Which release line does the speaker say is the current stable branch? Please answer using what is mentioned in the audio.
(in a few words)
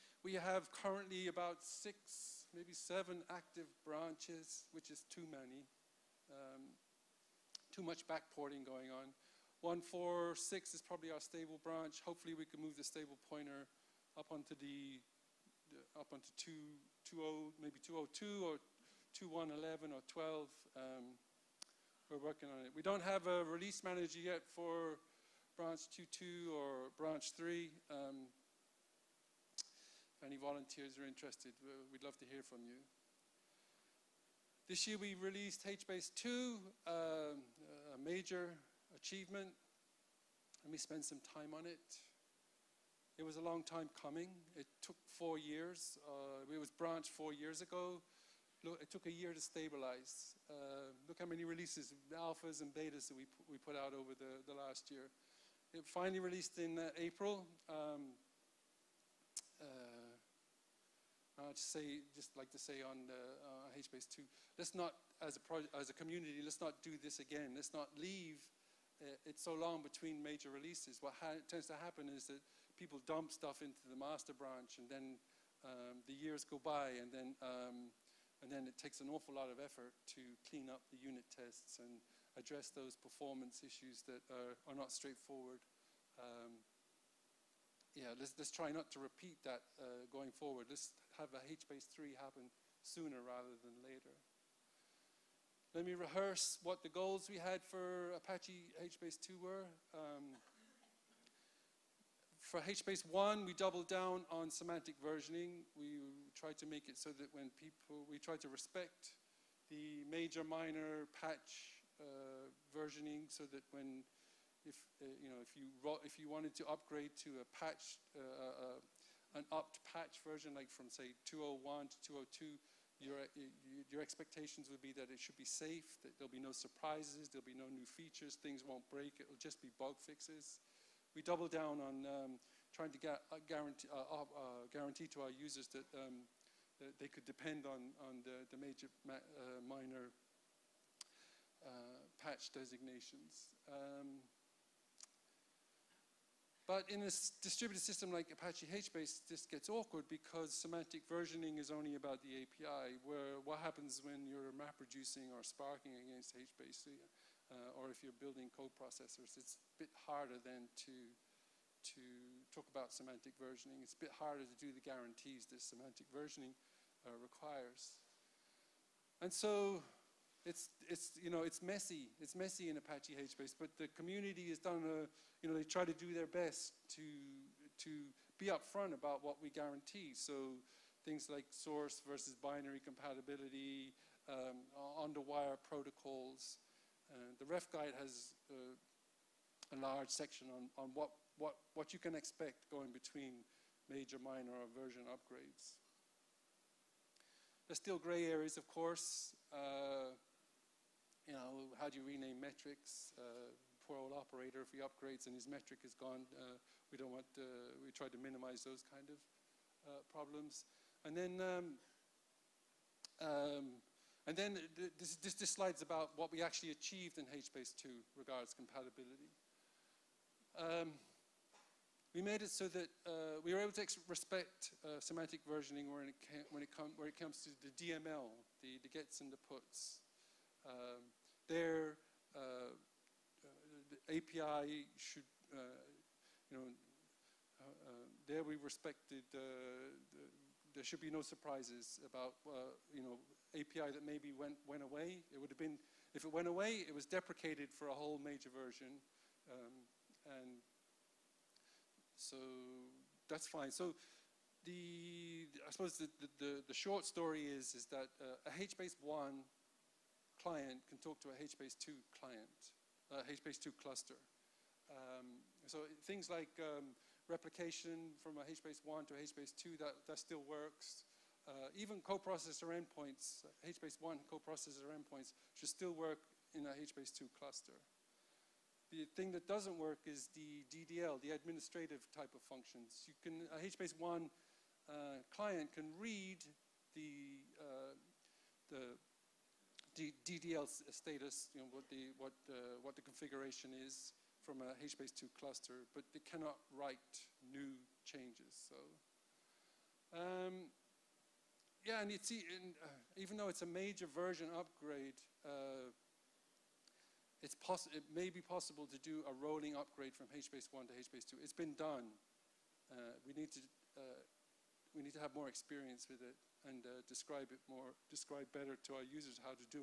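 1.4.6.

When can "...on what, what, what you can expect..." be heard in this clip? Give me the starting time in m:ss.
3:10.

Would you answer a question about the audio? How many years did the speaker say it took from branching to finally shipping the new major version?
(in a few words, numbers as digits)
4 years.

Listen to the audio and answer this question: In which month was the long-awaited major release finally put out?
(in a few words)
April.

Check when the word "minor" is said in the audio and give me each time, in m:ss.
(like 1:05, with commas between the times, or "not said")
1:50, 2:19, 3:14.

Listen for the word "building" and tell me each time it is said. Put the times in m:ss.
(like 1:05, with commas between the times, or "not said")
2:38.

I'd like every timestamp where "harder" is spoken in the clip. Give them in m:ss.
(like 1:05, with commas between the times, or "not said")
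2:40, 2:44.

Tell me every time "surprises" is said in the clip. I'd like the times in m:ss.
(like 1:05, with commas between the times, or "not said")
2:06, 4:01.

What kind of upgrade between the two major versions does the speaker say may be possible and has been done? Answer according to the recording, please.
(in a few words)
rolling upgrade.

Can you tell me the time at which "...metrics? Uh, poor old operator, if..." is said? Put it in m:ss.
3:22.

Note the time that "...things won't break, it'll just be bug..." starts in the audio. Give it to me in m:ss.
2:08.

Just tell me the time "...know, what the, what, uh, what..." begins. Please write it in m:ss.
4:51.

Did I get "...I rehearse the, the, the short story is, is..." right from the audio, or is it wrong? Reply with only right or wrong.
wrong.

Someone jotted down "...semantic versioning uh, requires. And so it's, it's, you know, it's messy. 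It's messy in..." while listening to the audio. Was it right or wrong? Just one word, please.
right.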